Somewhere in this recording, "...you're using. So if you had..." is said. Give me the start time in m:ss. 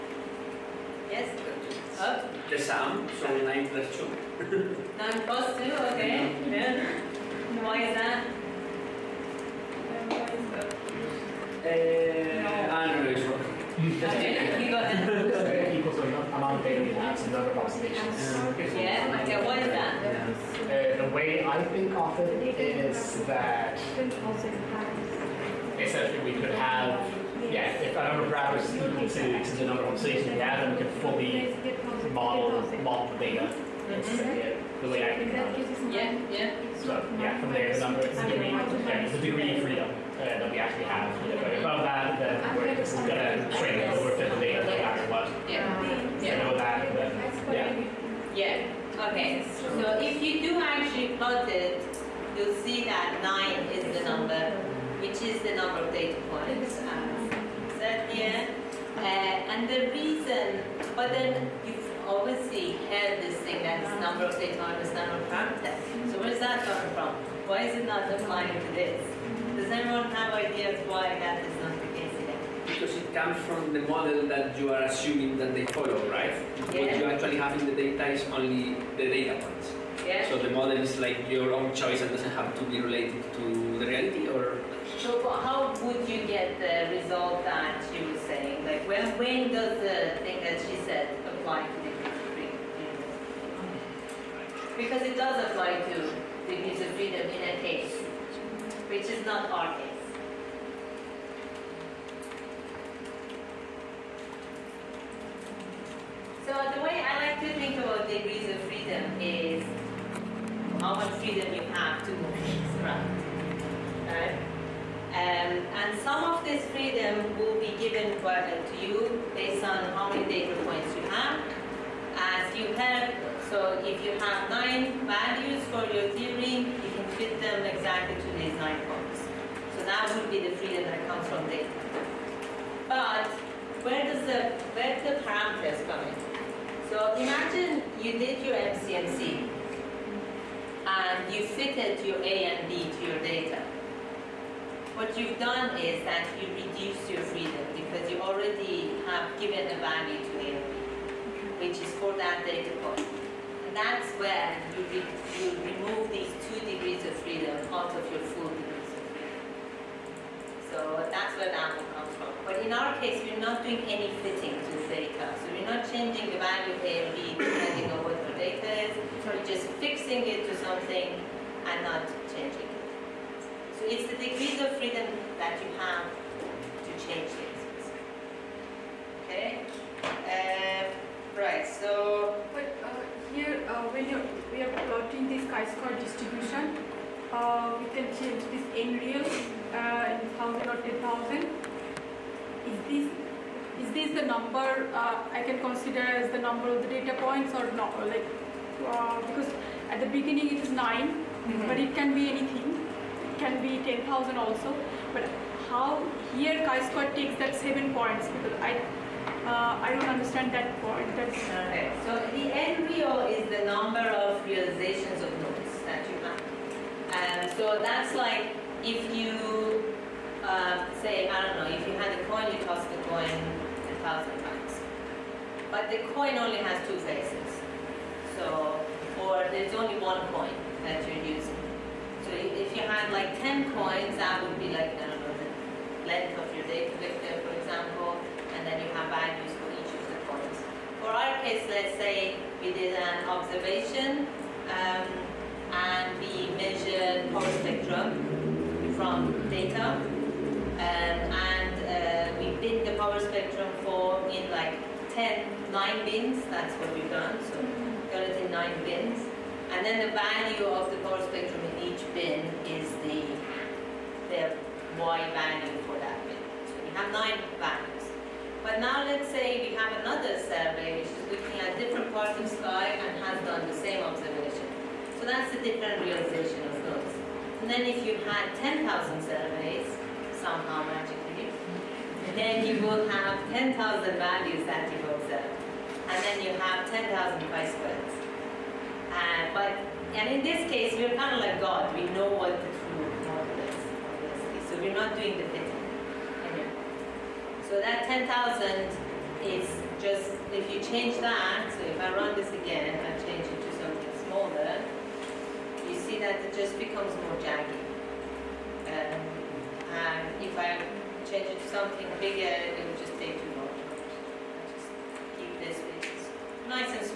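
3:51.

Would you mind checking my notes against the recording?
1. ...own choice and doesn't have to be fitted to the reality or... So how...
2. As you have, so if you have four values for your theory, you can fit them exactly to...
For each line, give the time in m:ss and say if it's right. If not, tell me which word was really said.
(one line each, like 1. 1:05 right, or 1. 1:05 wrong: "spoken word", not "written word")
1. 1:21 wrong: "related", not "fitted"
2. 2:02 wrong: "nine", not "four".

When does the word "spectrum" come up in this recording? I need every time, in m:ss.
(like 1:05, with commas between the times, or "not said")
4:07, 4:13, 4:21.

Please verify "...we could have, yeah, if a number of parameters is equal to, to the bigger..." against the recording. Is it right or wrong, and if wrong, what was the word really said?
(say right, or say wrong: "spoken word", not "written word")
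wrong: "number", not "bigger".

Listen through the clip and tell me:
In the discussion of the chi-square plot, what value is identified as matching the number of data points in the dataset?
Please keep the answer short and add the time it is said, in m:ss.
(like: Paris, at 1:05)
9, at 0:53.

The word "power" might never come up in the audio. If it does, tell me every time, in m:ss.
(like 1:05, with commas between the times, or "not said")
4:07, 4:12, 4:20.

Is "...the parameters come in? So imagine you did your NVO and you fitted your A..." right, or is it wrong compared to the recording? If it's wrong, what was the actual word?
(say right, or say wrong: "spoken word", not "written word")
wrong: "MCMC", not "NVO".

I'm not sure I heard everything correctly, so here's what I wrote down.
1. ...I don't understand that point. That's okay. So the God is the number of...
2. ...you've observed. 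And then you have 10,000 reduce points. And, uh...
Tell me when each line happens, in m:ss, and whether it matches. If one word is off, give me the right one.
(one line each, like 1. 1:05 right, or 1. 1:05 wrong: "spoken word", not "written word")
1. 3:29 wrong: "NVO", not "God"
2. 4:44 wrong: "price", not "reduce".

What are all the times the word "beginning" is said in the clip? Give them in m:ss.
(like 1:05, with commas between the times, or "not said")
3:20.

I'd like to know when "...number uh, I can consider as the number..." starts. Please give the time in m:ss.
3:14.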